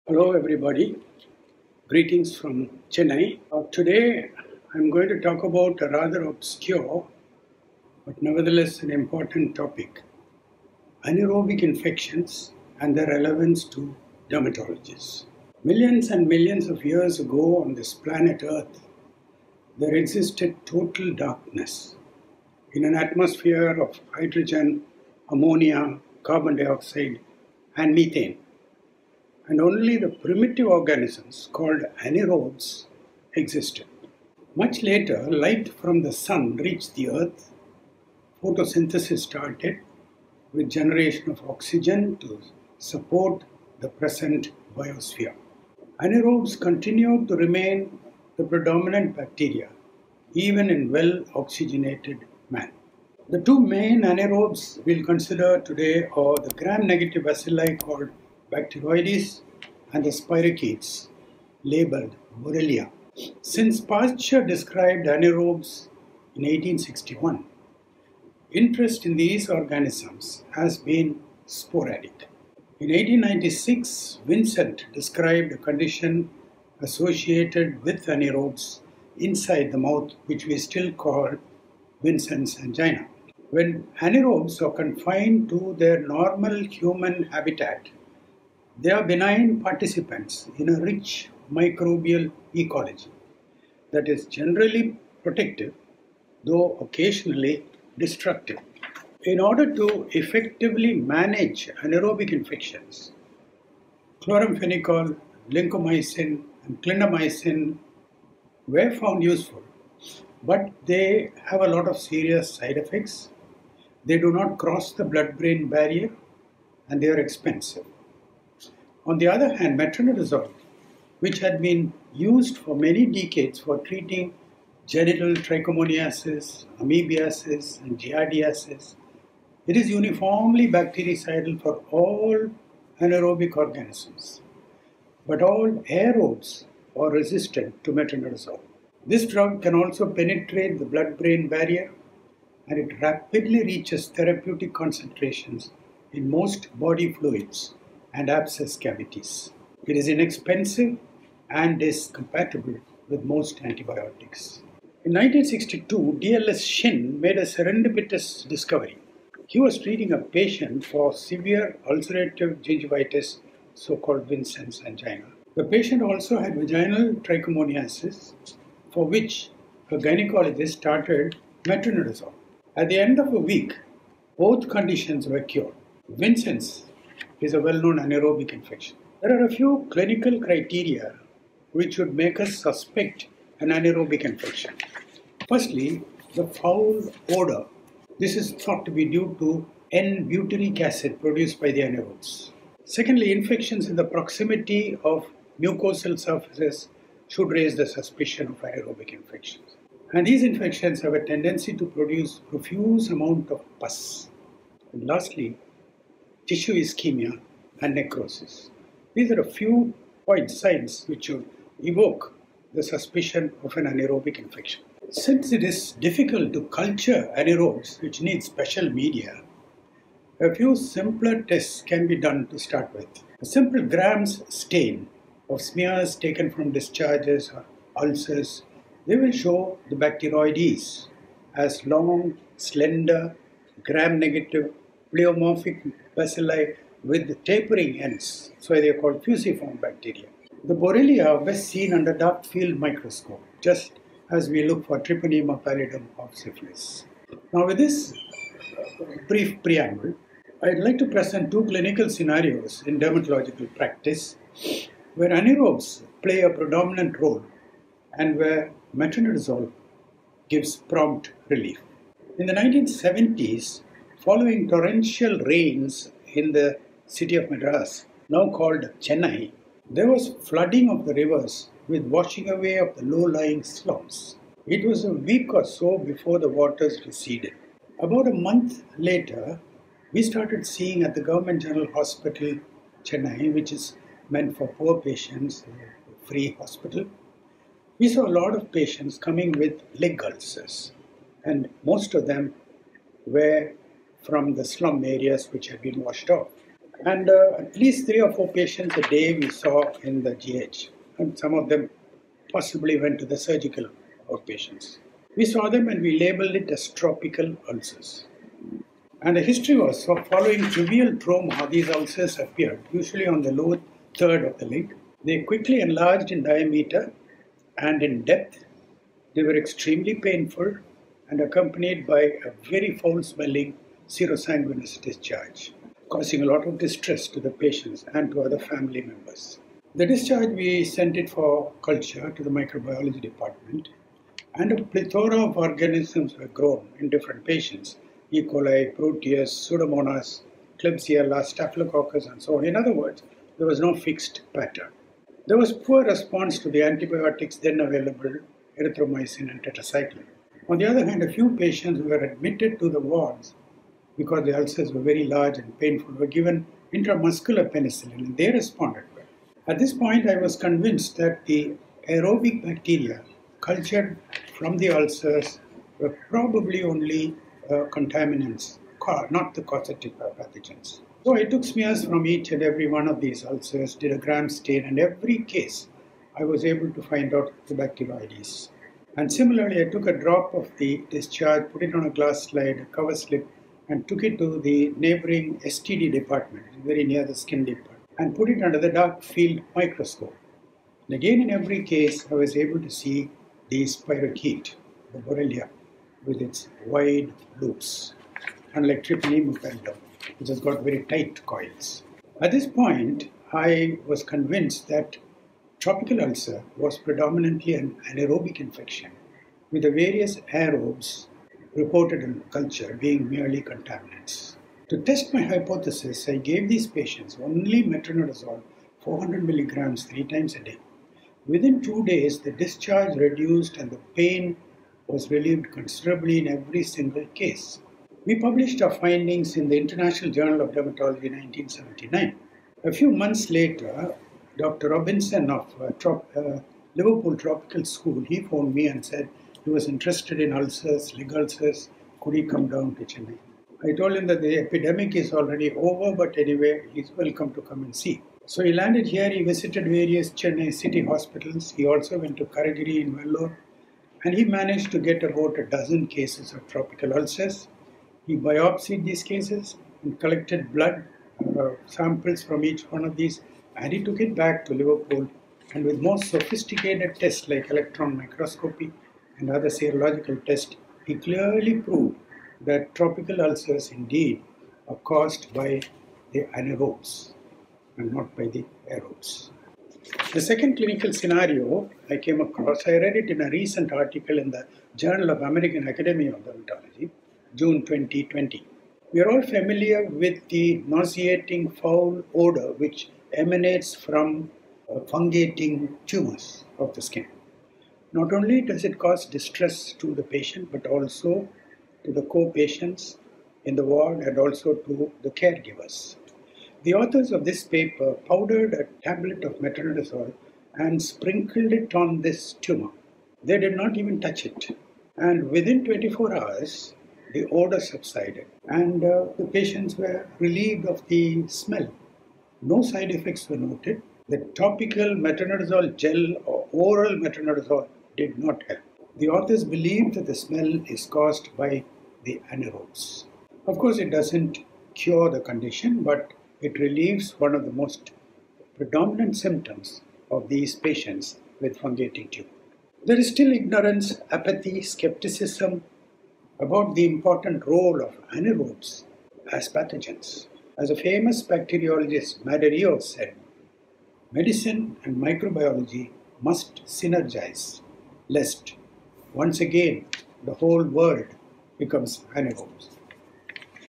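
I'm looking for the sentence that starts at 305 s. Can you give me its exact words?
We saw them and we labeled it as tropical ulcers.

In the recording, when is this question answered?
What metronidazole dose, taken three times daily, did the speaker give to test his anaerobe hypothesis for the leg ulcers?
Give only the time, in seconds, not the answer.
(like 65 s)
419 s.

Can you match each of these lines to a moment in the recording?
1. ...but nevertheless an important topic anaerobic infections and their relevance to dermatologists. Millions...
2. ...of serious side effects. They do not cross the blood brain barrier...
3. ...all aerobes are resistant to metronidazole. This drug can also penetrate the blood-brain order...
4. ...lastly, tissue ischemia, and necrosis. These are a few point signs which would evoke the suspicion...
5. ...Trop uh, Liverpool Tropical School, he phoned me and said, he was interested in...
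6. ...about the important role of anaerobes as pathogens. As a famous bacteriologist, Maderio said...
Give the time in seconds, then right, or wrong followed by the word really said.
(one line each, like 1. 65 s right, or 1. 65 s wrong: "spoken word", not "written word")
1. 8 s right
2. 111 s right
3. 135 s wrong: "barrier", not "order"
4. 205 s right
5. 435 s right
6. 546 s right.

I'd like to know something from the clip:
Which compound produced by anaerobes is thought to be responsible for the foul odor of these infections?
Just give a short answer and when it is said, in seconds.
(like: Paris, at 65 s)
N-butyric acid, at 189 s.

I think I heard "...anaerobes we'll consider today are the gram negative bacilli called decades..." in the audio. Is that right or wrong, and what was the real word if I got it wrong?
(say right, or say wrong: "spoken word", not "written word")
wrong: "bacteroides", not "decades".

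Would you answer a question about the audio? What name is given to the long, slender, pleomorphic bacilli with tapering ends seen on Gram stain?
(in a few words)
fusiform bacteria.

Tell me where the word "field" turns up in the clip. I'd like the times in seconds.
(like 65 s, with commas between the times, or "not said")
242 s, 389 s.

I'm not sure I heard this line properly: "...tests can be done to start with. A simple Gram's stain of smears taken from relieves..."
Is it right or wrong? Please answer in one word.
wrong.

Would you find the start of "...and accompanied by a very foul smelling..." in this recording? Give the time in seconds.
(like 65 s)
321 s.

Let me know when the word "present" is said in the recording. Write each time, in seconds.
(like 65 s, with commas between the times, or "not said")
43 s, 251 s.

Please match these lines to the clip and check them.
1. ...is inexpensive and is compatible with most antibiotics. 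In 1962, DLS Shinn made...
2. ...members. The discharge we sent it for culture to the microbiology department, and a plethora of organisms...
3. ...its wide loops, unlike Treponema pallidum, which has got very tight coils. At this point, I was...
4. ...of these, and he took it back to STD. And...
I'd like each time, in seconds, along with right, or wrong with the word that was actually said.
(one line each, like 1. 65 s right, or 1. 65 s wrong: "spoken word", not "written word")
1. 149 s right
2. 329 s right
3. 396 s right
4. 463 s wrong: "Liverpool", not "STD".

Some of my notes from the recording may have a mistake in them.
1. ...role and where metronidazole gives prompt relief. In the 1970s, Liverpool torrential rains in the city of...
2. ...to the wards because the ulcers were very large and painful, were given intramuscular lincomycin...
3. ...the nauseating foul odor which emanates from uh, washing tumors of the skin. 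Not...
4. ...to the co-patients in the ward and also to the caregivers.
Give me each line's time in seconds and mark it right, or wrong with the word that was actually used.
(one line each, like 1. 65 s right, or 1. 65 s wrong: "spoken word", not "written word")
1. 257 s wrong: "Following", not "Liverpool"
2. 352 s wrong: "penicillin", not "lincomycin"
3. 490 s wrong: "fungating", not "washing"
4. 502 s right.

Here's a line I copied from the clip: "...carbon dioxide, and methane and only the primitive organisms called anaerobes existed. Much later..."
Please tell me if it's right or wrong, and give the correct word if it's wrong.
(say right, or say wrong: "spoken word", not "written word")
right.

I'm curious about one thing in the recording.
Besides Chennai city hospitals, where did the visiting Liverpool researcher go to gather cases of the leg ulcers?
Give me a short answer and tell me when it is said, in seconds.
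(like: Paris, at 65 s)
Karigiri, at 452 s.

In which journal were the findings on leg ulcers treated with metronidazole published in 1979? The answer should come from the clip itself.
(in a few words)
International Journal of Dermatology.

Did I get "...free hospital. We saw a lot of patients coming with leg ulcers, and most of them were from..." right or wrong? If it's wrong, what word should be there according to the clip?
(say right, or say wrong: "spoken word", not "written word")
right.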